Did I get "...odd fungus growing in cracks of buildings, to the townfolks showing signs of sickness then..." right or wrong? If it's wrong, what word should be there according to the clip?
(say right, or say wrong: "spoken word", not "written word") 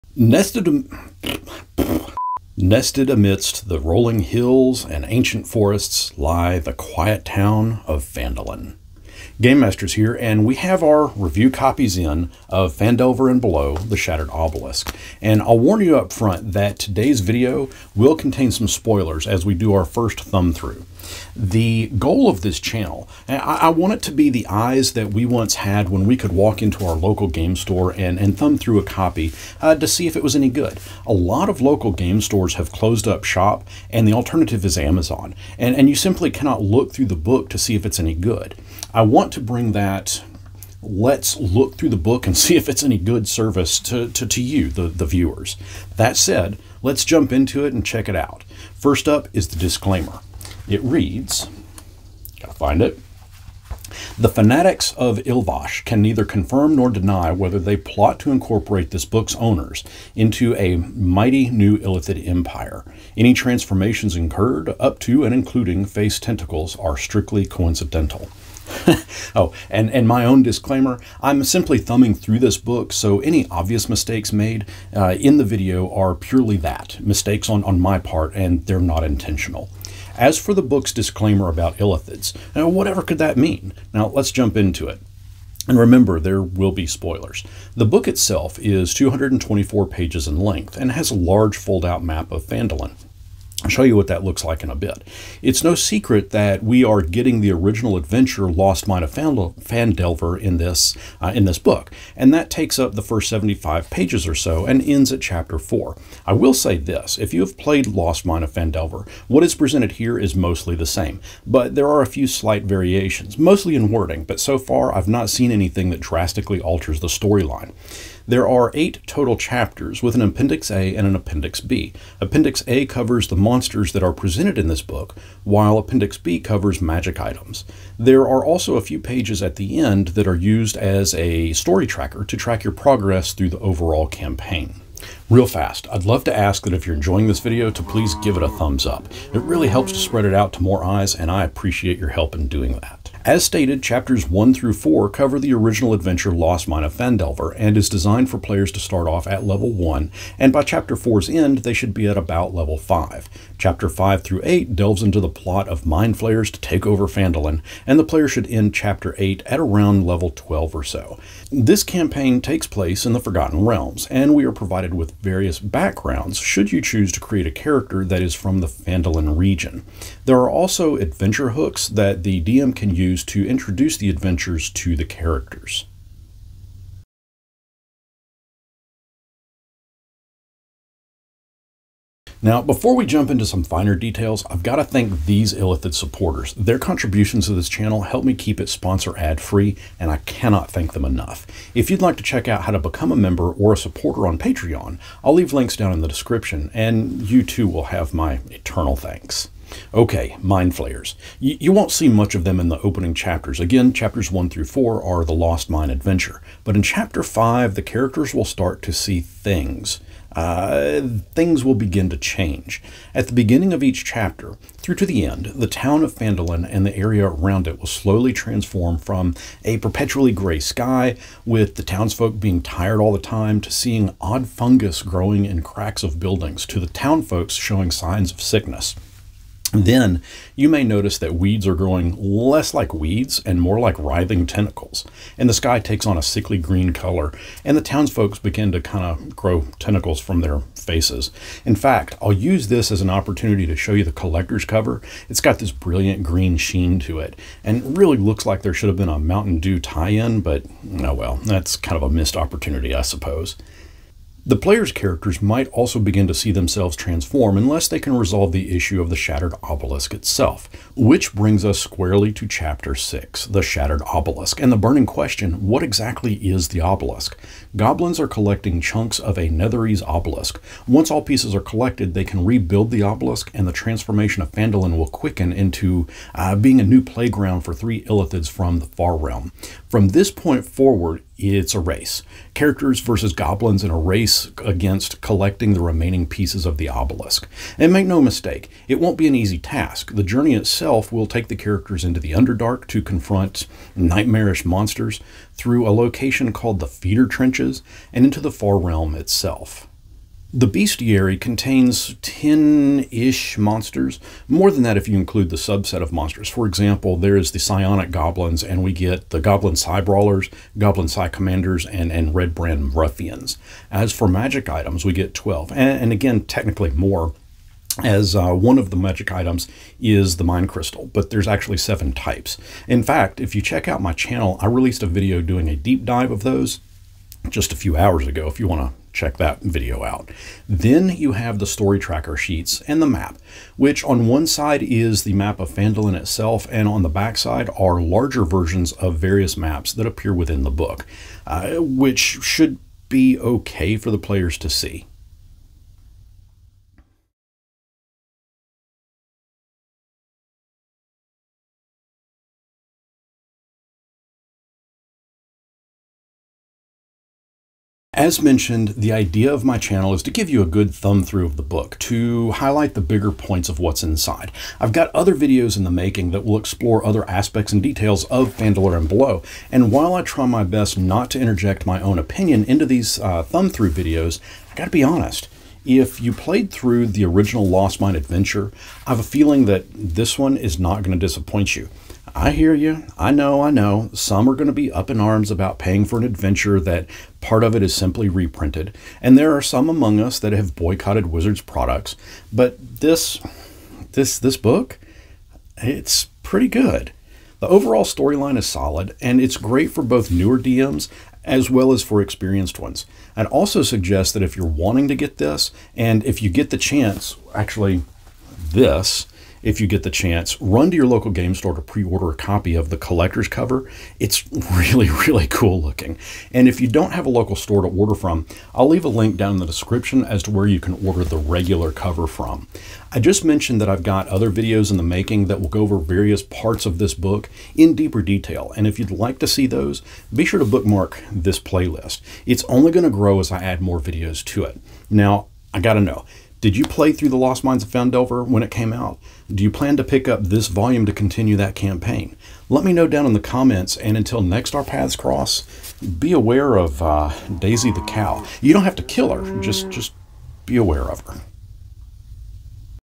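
right.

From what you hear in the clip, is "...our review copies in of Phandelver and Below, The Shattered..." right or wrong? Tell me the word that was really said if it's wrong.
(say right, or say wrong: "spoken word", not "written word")
right.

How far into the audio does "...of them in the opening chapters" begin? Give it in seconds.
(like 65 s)
202 s.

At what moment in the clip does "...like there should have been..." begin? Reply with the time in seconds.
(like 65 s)
248 s.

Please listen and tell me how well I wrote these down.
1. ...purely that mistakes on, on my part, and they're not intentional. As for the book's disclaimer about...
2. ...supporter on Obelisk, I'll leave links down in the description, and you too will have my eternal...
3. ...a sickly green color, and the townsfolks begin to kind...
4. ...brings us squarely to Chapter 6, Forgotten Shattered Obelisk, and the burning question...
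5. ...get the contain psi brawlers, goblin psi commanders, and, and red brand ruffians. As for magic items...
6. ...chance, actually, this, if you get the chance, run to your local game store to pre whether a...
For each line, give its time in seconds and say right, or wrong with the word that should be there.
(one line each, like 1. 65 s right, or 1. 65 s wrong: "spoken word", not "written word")
1. 76 s right
2. 193 s wrong: "Patreon", not "Obelisk"
3. 236 s right
4. 261 s wrong: "The", not "Forgotten"
5. 308 s wrong: "goblin", not "contain"
6. 406 s wrong: "order", not "whether".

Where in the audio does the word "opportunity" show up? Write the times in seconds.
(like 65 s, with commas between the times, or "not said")
243 s, 252 s.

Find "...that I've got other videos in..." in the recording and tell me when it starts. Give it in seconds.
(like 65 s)
423 s.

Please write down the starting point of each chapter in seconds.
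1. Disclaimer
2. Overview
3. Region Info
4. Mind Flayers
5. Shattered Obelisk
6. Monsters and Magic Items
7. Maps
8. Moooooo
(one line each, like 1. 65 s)
1. 48 s
2. 87 s
3. 142 s
4. 198 s
5. 252 s
6. 300 s
7. 330 s
8. 357 s.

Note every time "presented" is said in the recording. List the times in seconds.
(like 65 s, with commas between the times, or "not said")
109 s, 124 s.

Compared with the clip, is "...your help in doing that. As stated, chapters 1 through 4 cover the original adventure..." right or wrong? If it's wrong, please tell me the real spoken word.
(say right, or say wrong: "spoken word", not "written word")
right.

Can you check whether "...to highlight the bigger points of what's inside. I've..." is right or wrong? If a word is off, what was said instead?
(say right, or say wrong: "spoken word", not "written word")
right.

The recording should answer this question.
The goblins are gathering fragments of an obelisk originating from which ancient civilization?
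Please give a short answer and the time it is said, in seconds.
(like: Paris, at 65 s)
Netherese, at 269 s.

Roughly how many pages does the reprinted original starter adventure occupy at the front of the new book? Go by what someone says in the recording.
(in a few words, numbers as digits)
75.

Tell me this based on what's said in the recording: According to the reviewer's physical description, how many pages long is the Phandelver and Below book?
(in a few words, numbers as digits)
224.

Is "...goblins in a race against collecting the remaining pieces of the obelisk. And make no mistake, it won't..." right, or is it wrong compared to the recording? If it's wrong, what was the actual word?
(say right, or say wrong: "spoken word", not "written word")
right.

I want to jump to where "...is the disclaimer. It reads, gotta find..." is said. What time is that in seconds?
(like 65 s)
49 s.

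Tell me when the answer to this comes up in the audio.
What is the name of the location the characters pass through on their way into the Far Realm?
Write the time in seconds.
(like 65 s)
296 s.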